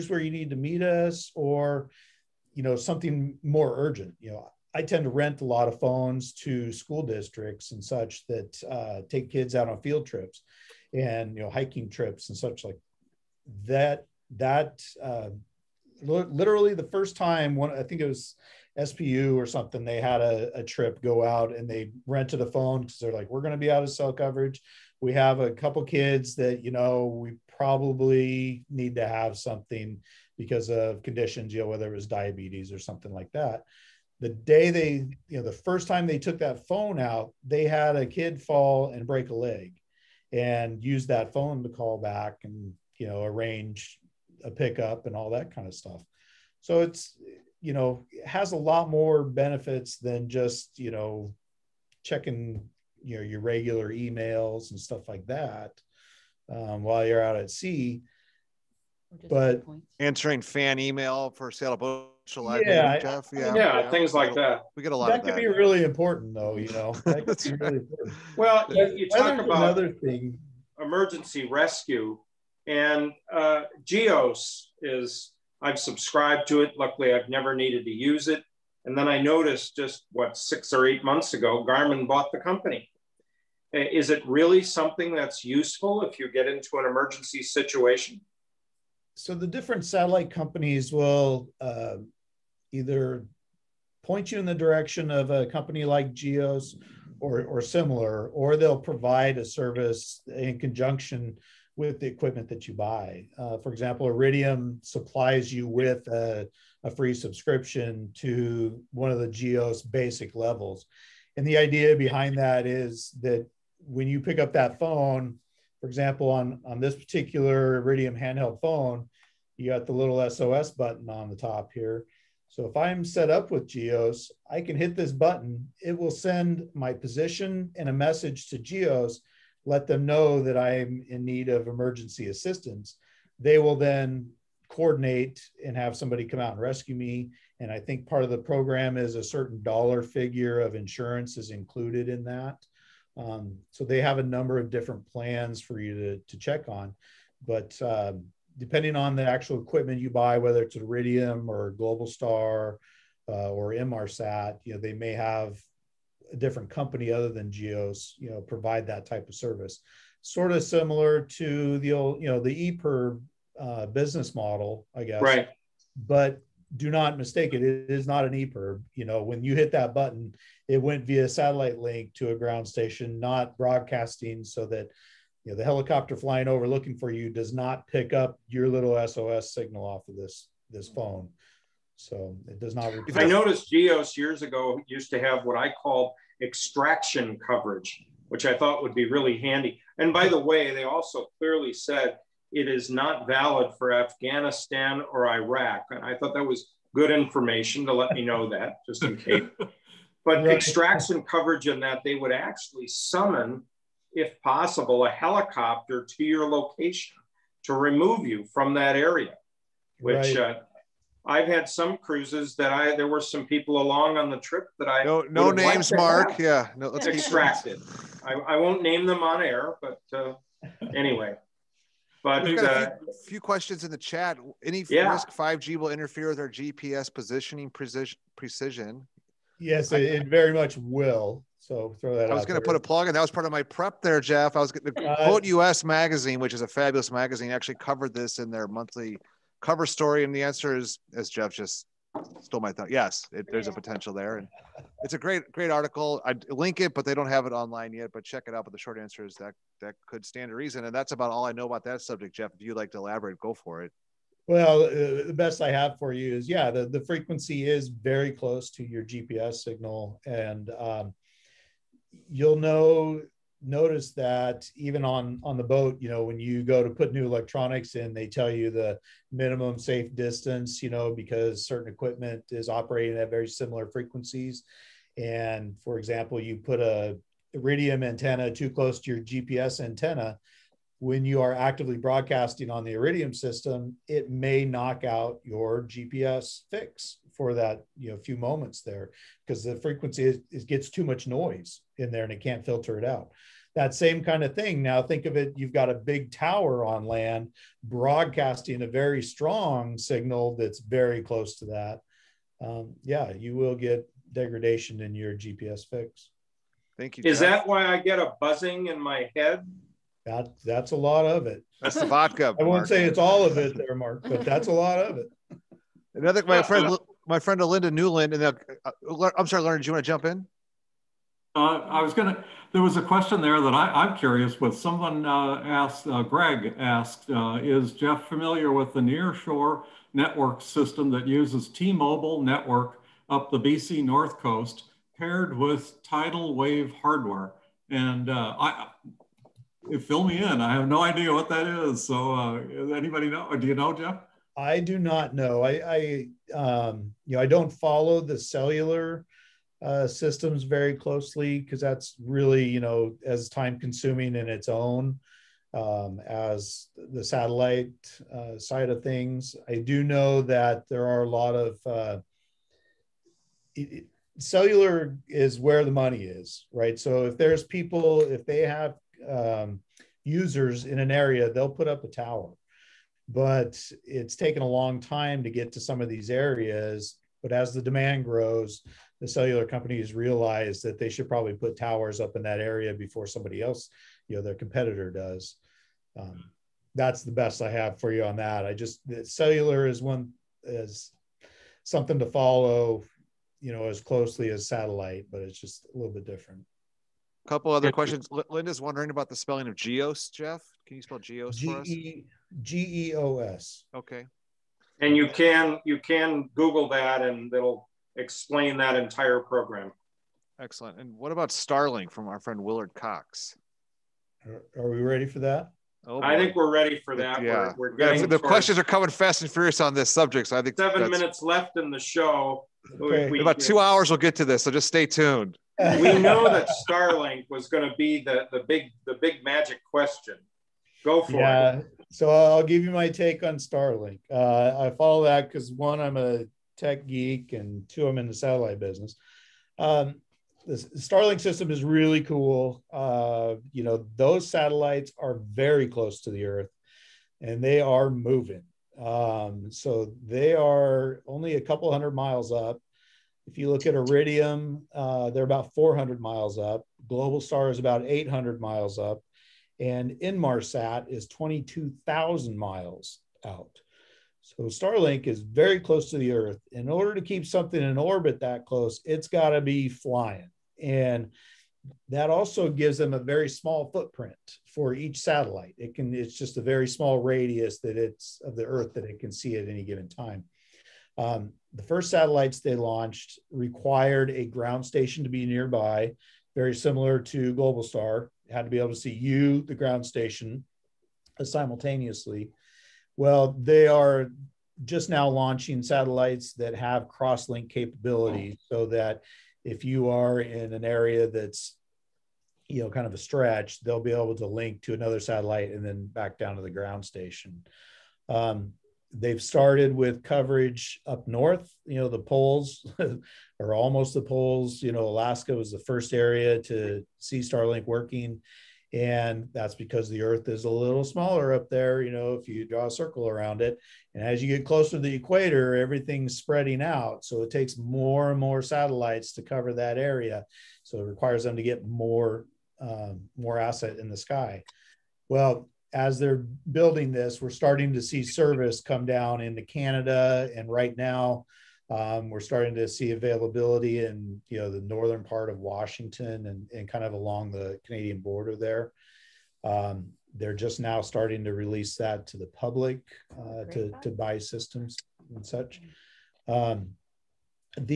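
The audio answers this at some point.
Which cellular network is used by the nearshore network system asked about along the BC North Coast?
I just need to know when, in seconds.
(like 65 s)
331 s.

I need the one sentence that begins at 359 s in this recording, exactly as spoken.
I do know that there are a lot of uh, it, cellular is where the money is, right?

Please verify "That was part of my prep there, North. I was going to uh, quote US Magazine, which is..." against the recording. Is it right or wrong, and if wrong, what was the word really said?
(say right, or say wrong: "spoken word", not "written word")
wrong: "Jeff", not "North".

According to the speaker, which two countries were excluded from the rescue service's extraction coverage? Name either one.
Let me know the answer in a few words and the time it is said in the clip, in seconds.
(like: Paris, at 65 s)
Afghanistan or Iraq, at 193 s.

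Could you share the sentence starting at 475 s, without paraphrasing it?
It can, it's just a very small radius that it's of the Earth that it can see at any given time.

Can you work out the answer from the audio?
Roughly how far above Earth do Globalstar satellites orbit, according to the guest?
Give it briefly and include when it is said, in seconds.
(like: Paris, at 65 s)
800 miles, at 458 s.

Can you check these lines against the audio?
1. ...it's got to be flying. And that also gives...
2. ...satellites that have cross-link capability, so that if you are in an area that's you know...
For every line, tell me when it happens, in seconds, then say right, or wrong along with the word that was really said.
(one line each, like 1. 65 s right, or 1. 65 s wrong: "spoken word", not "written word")
1. 469 s right
2. 495 s right.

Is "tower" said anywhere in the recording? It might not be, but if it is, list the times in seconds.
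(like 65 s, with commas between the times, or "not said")
296 s, 372 s, 381 s.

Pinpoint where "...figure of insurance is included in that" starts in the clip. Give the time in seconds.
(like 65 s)
140 s.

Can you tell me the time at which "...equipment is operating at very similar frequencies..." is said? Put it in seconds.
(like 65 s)
271 s.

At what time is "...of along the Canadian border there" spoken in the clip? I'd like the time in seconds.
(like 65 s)
547 s.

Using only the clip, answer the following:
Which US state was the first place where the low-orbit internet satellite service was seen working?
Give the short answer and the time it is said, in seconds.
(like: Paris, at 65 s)
Alaska, at 515 s.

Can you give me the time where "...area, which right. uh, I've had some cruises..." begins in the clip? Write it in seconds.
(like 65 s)
208 s.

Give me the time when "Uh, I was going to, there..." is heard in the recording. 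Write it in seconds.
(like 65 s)
321 s.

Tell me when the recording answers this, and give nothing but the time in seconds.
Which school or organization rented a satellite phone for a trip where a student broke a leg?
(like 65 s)
18 s.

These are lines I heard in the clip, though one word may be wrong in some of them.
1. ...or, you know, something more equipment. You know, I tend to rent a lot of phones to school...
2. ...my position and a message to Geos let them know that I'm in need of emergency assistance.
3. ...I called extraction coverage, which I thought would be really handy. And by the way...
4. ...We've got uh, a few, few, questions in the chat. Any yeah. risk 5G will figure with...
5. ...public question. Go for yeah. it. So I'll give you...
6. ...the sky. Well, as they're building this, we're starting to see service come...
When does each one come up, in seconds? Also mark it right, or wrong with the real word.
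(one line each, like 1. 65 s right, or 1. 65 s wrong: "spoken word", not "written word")
1. 1 s wrong: "urgent", not "equipment"
2. 126 s right
3. 185 s right
4. 222 s wrong: "interfere", not "figure"
5. 429 s wrong: "magic", not "public"
6. 534 s right.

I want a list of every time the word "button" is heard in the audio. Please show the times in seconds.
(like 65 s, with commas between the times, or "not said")
120 s, 125 s, 169 s.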